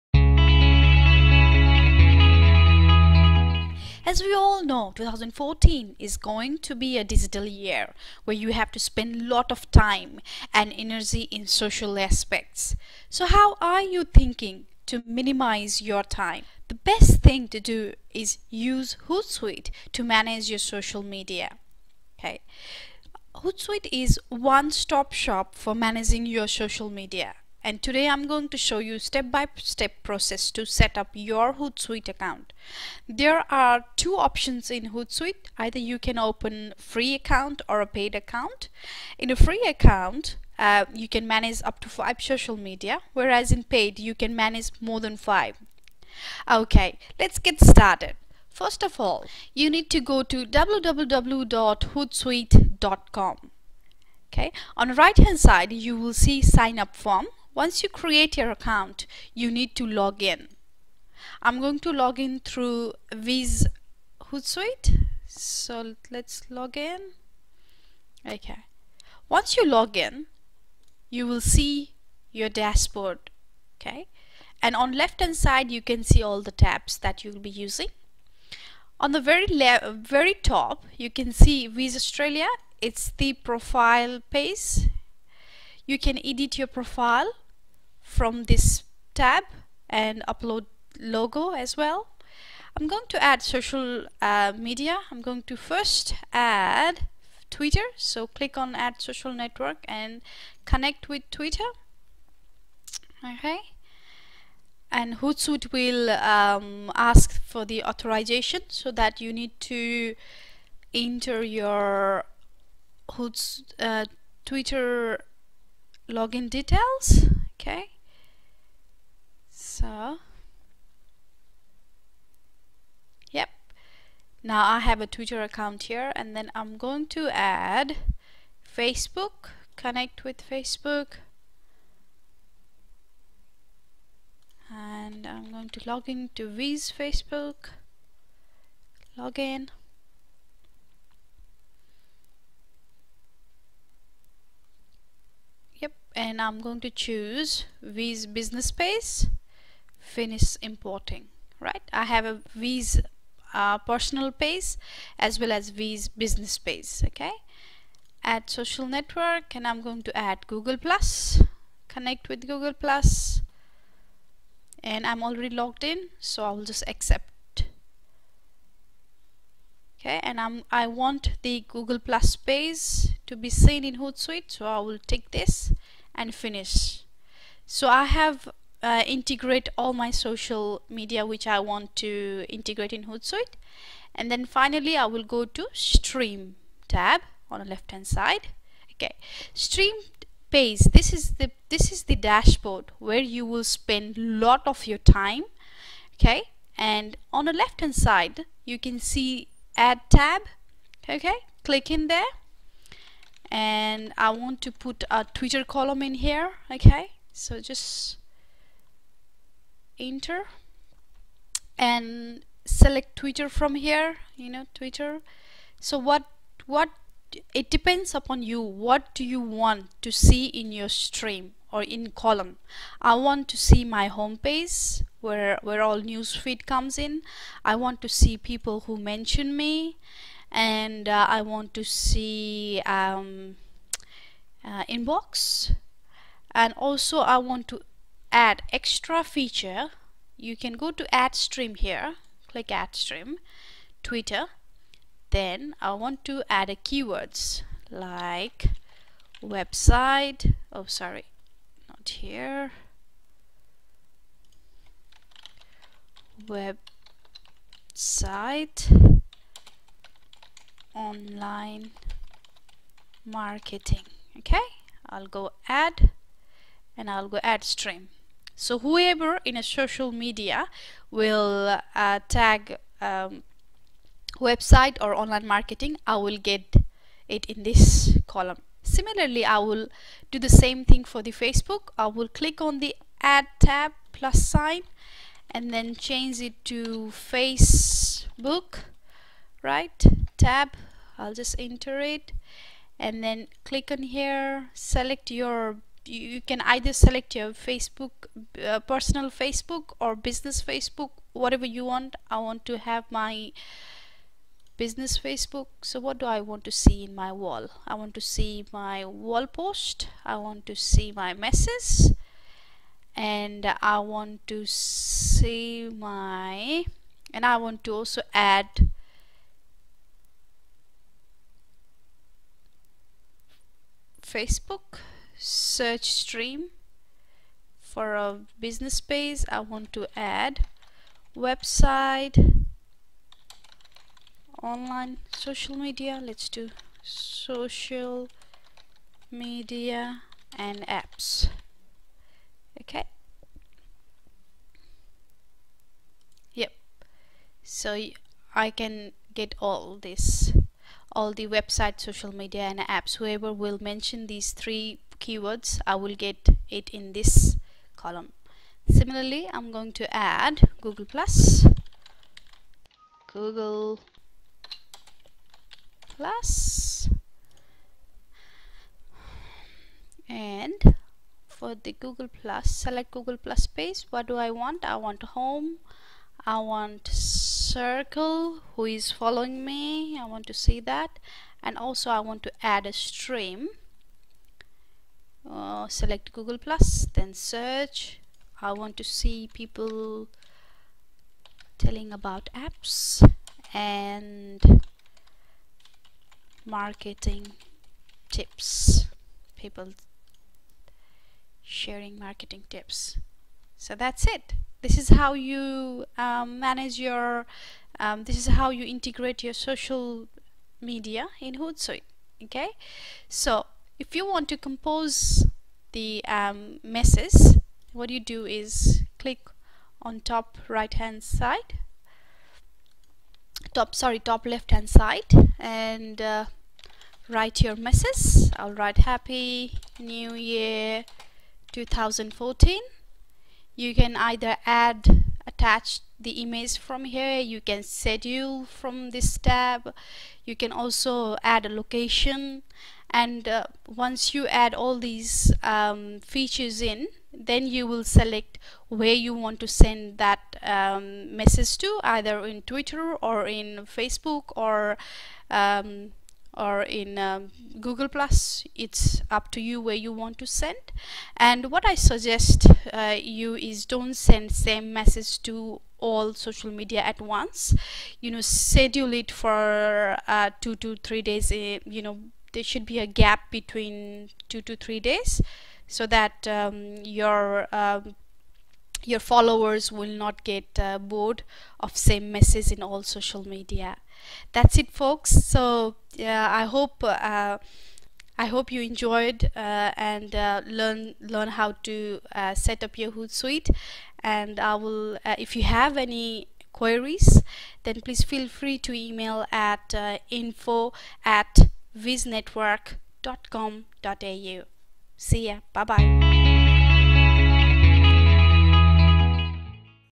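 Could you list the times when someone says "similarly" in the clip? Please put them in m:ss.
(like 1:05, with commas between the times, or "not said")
4:38, 5:58.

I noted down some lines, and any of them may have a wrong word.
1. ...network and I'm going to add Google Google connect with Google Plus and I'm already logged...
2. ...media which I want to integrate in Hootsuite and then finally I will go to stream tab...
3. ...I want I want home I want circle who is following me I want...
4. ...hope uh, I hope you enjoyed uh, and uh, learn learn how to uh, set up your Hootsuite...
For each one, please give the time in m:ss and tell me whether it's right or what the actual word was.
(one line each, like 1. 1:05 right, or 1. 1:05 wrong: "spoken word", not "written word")
1. 2:38 wrong: "Plus", not "Google"
2. 3:00 right
3. 6:14 right
4. 8:06 right.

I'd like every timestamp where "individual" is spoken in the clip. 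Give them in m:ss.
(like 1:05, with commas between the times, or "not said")
not said.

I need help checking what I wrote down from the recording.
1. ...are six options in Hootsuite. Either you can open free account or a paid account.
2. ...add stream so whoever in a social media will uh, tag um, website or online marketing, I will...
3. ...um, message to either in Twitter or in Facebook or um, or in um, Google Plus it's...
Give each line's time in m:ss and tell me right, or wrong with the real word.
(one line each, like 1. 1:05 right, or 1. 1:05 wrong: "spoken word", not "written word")
1. 0:33 wrong: "two", not "six"
2. 4:27 right
3. 7:30 right.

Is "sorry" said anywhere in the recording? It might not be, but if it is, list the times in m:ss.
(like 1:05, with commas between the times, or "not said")
4:10, 7:03.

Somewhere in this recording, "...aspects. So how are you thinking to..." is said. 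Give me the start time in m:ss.
0:11.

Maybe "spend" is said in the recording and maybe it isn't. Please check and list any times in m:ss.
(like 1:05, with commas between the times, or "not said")
0:08, 3:13.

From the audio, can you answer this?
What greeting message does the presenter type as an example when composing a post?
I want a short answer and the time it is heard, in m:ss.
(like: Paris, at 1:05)
Happy New Year, at 7:08.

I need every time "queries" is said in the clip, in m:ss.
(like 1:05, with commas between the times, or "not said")
8:16.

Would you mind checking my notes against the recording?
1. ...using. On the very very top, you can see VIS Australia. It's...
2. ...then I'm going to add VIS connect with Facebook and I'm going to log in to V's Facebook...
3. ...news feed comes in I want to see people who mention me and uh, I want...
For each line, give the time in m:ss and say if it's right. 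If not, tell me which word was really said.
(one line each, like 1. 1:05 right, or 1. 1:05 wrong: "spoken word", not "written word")
1. 1:17 right
2. 2:06 wrong: "Facebook", not "VIS"
3. 3:46 right.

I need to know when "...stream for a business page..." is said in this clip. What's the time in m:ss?
5:26.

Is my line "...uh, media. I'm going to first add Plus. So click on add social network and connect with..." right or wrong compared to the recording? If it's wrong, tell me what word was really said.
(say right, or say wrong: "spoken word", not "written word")
wrong: "Twitter", not "Plus".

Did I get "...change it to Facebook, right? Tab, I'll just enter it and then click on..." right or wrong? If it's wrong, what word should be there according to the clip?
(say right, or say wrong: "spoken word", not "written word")
right.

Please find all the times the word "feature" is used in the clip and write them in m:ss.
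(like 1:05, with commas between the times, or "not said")
3:59, 7:26.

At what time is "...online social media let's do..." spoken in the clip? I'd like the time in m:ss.
5:34.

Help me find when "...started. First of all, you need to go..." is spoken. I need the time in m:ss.
0:47.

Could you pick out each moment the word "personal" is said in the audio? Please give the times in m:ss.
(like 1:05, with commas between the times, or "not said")
2:33, 4:58.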